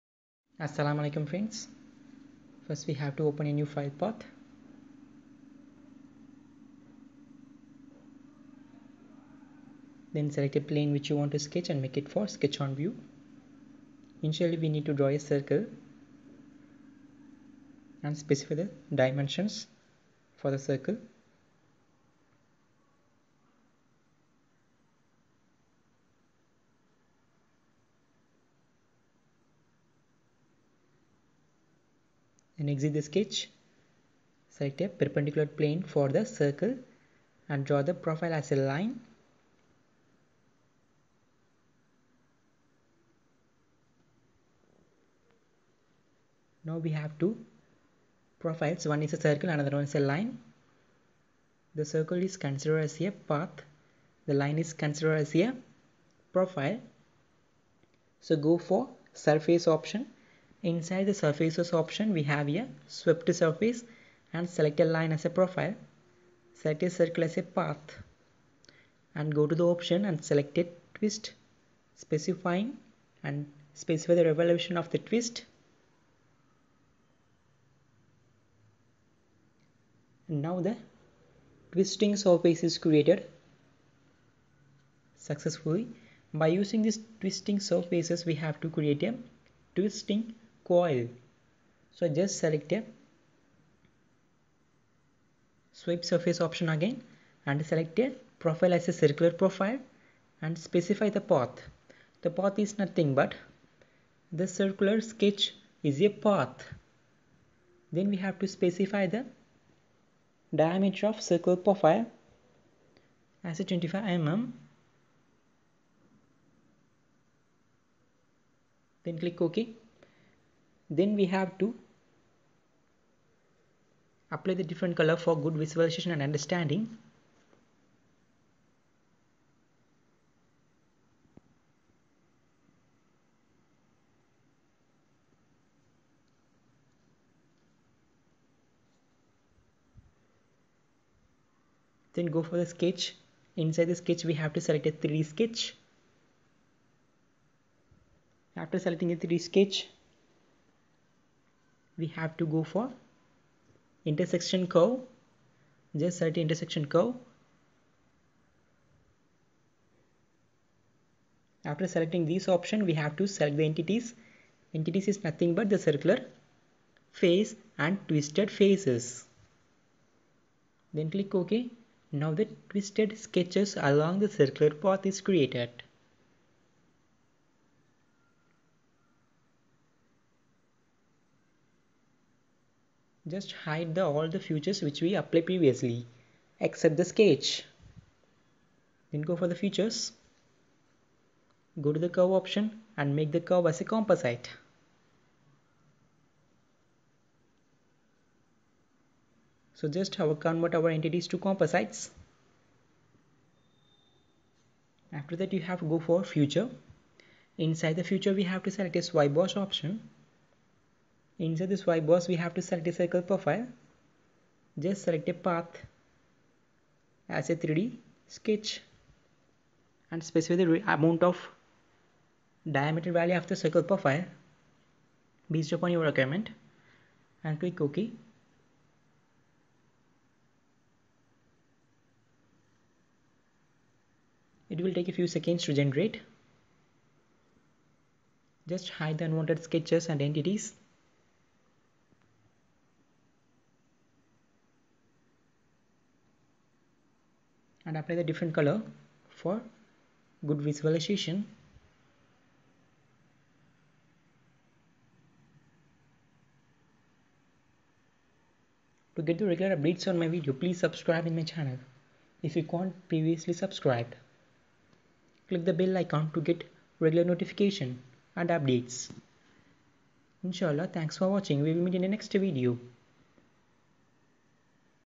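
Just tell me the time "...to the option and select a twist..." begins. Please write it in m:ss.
1:09.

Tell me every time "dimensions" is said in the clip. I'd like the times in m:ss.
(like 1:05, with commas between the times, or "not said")
0:19.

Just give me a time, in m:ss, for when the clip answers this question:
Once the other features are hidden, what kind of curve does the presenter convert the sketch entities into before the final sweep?
3:13.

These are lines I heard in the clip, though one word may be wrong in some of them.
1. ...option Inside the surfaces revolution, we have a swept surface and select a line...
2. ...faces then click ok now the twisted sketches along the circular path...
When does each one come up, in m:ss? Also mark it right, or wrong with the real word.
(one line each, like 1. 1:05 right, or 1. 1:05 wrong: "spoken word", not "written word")
1. 0:59 wrong: "option", not "revolution"
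2. 2:48 right.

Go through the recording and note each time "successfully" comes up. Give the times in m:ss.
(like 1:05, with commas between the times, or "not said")
1:25.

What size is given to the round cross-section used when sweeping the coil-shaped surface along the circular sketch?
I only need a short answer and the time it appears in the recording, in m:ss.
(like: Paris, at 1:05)
25 mm, at 1:53.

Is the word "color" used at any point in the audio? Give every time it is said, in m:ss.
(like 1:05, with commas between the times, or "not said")
2:04, 4:08.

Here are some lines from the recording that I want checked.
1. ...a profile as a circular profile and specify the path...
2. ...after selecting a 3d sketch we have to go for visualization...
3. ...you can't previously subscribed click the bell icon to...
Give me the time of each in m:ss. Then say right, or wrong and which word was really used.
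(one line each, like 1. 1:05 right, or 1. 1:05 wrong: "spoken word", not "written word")
1. 1:37 right
2. 2:28 wrong: "intersection", not "visualization"
3. 4:22 right.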